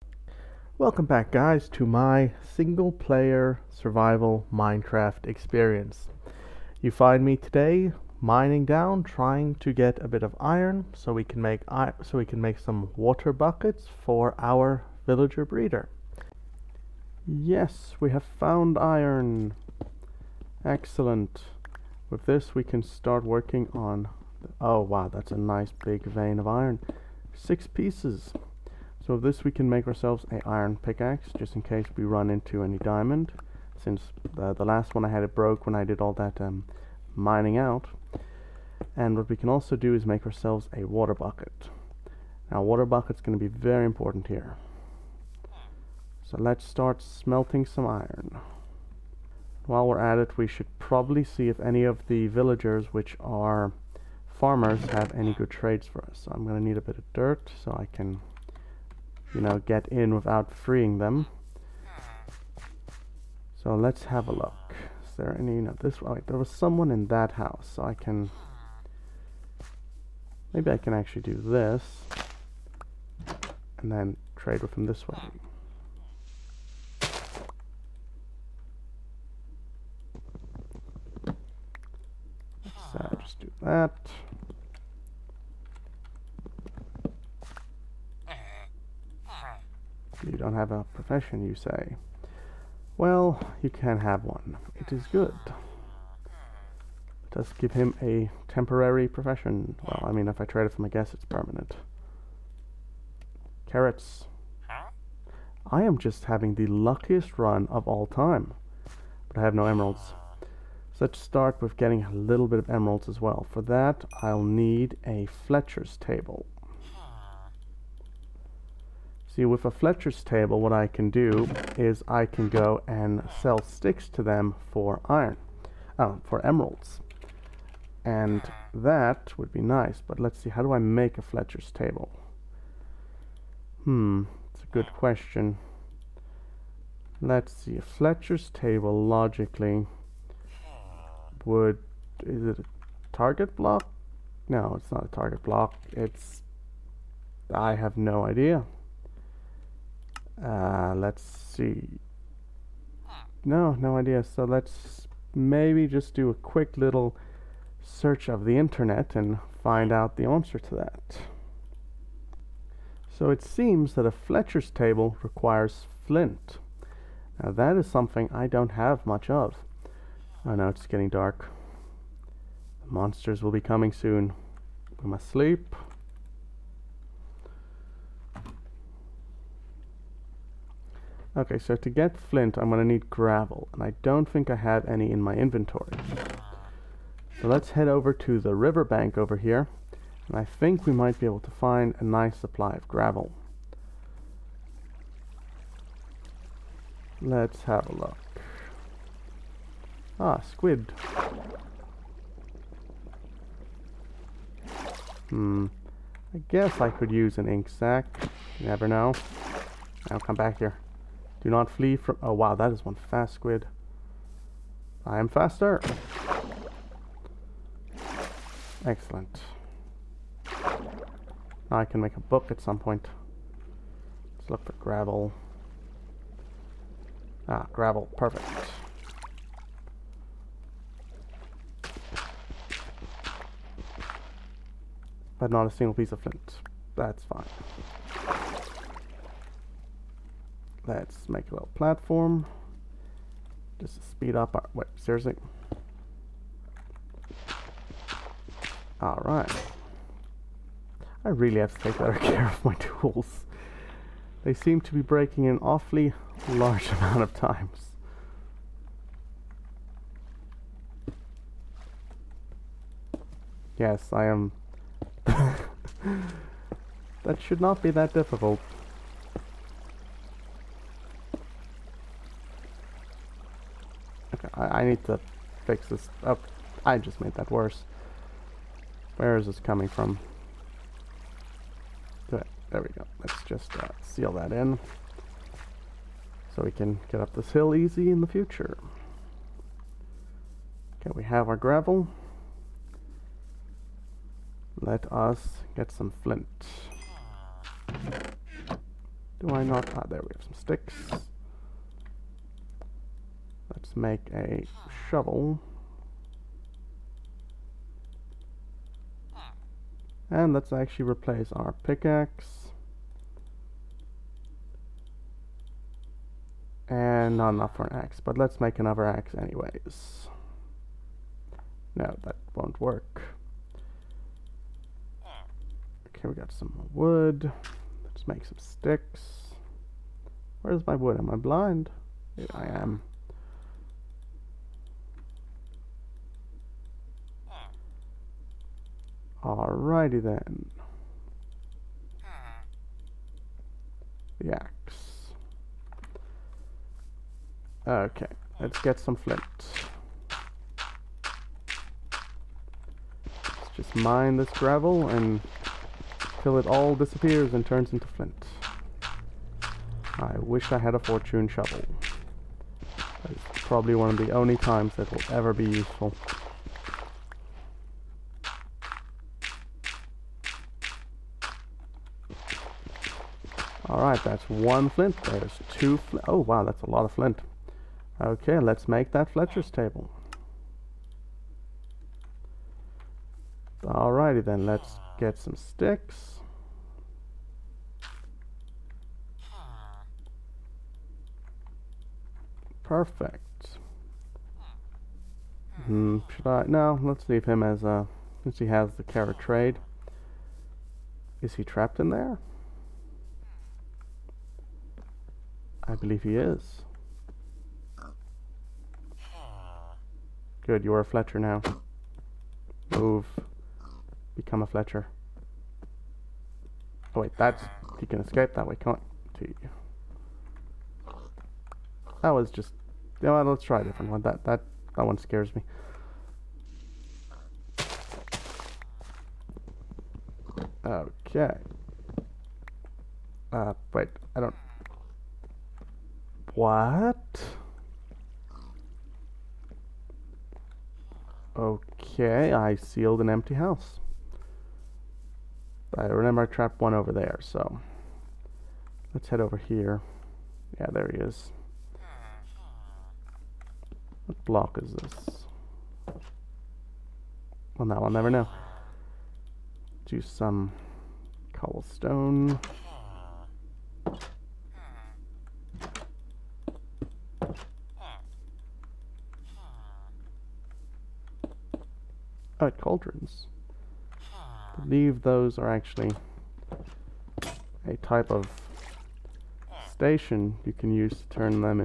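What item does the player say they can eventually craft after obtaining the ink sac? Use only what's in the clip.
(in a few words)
A book.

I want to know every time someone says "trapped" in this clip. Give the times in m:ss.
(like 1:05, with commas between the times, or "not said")
6:41, 7:26.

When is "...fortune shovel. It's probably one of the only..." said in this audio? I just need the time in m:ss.
6:01.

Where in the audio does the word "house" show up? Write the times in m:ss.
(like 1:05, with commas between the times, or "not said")
1:07, 7:23.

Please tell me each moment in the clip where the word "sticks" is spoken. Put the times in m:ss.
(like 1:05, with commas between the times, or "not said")
2:03, 5:00, 5:28, 6:25.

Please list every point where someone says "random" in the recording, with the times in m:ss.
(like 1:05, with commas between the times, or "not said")
not said.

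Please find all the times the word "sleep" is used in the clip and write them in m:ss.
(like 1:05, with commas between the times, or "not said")
2:55.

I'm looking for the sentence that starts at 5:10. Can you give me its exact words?
And let's actually replace our pickaxe.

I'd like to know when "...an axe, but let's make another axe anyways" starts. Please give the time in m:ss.
5:17.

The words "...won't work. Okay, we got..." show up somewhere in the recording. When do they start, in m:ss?
5:22.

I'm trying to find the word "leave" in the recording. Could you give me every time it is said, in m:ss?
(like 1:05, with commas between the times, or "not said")
6:37.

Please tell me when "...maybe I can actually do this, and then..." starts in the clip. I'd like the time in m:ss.
1:10.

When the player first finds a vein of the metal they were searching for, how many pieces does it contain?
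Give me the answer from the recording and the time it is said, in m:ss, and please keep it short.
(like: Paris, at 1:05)
6, at 0:27.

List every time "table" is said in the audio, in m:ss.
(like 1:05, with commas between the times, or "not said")
1:55, 2:00, 2:11, 2:18, 2:44, 6:19.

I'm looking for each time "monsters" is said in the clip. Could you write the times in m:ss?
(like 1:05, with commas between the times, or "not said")
2:52.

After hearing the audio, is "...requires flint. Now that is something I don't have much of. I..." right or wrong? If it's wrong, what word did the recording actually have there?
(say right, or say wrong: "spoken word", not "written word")
right.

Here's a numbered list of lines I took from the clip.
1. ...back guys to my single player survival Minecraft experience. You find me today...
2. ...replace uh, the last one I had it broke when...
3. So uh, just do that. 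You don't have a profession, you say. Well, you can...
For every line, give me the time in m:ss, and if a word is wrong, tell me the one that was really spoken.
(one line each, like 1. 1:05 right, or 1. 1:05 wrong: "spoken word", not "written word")
1. 0:01 right
2. 0:33 wrong: "since", not "replace"
3. 1:22 right.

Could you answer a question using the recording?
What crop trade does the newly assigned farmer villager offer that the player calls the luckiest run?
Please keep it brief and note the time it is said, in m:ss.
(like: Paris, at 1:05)
Carrots, at 1:43.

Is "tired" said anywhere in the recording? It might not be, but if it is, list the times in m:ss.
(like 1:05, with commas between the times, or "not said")
not said.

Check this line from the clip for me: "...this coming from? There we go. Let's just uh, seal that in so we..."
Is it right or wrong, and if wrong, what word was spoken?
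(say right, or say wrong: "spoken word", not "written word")
right.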